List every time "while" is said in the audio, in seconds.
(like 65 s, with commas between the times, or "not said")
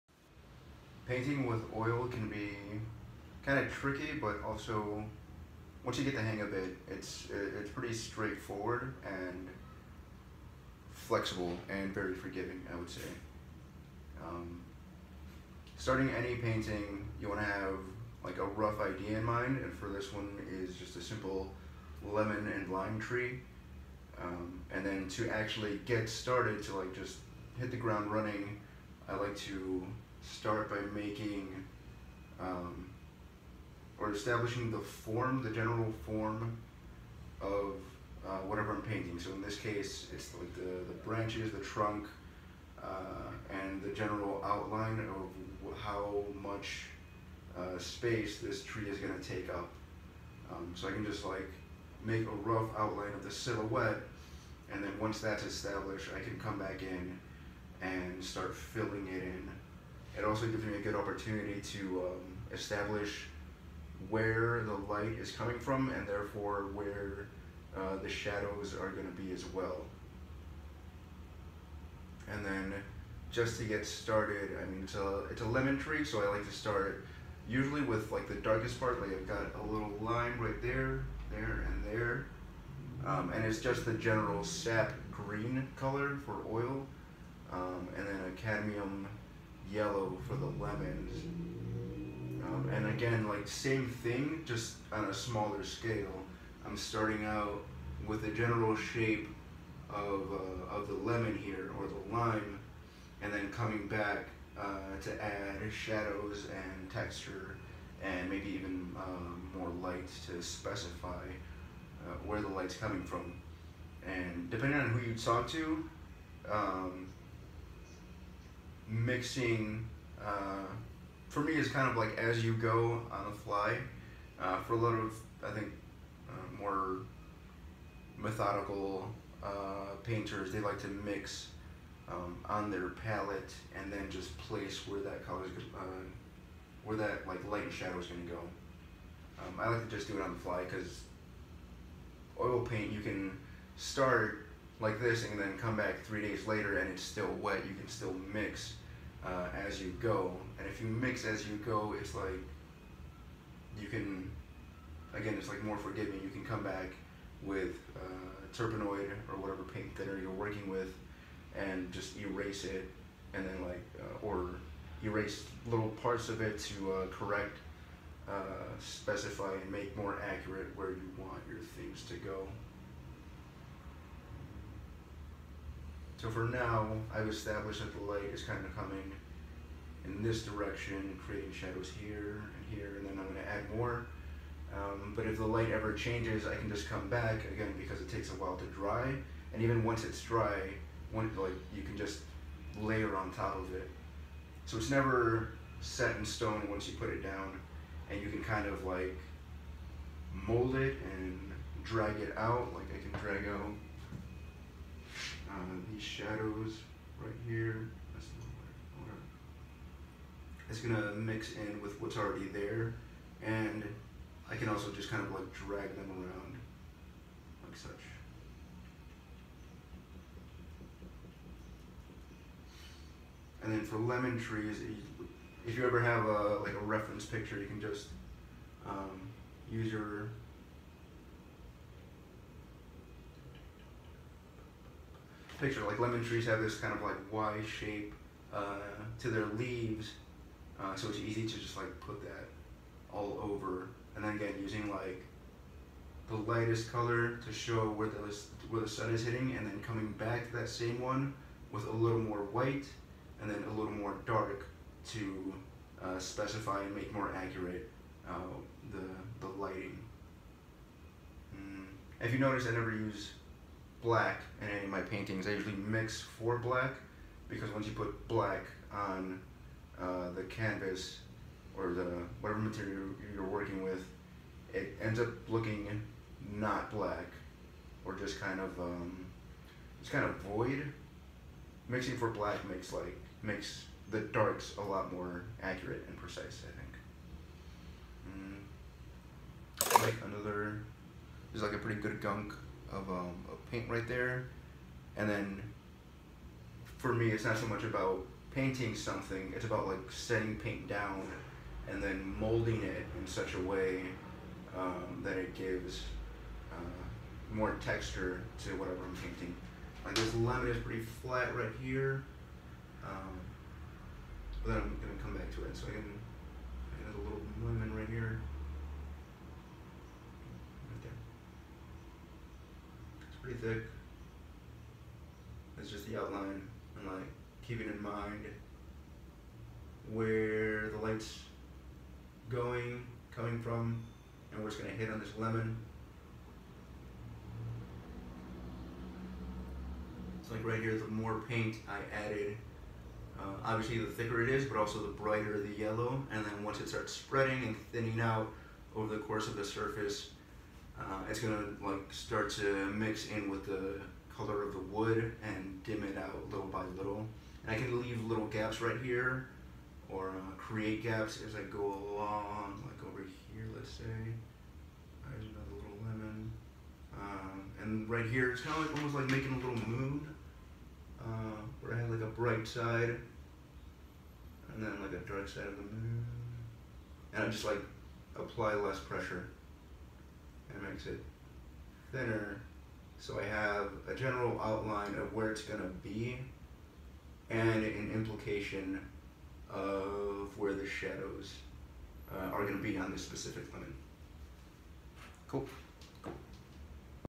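188 s.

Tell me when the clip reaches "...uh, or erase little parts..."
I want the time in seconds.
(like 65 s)
163 s.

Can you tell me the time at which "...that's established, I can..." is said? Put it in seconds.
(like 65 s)
55 s.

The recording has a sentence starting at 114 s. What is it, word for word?
And depending on who you talk to, um, mixing uh, for me is kind of like as you go on the fly.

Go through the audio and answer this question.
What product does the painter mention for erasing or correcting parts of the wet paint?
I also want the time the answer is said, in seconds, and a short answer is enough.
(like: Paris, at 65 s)
Turpenoid, at 158 s.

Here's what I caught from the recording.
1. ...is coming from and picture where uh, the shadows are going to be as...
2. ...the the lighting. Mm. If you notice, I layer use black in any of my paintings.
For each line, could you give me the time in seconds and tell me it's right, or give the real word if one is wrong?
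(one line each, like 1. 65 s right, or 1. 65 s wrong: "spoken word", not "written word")
1. 65 s wrong: "therefore", not "picture"
2. 258 s wrong: "never", not "layer".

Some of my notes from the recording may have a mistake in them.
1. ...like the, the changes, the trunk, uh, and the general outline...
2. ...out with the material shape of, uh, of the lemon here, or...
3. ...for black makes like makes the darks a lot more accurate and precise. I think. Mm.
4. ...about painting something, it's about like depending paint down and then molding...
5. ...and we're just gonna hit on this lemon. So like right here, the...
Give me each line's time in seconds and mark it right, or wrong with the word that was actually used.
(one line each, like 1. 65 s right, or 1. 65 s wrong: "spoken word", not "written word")
1. 40 s wrong: "branches", not "changes"
2. 97 s wrong: "general", not "material"
3. 282 s right
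4. 297 s wrong: "setting", not "depending"
5. 334 s right.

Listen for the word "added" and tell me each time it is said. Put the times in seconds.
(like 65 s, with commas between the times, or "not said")
342 s.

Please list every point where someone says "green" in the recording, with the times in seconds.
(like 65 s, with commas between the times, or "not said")
85 s.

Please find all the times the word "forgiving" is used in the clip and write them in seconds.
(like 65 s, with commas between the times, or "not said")
12 s, 155 s.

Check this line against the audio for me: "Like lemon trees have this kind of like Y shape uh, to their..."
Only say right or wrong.
right.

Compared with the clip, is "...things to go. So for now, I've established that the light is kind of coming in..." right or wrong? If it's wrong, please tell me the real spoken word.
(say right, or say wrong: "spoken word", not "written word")
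right.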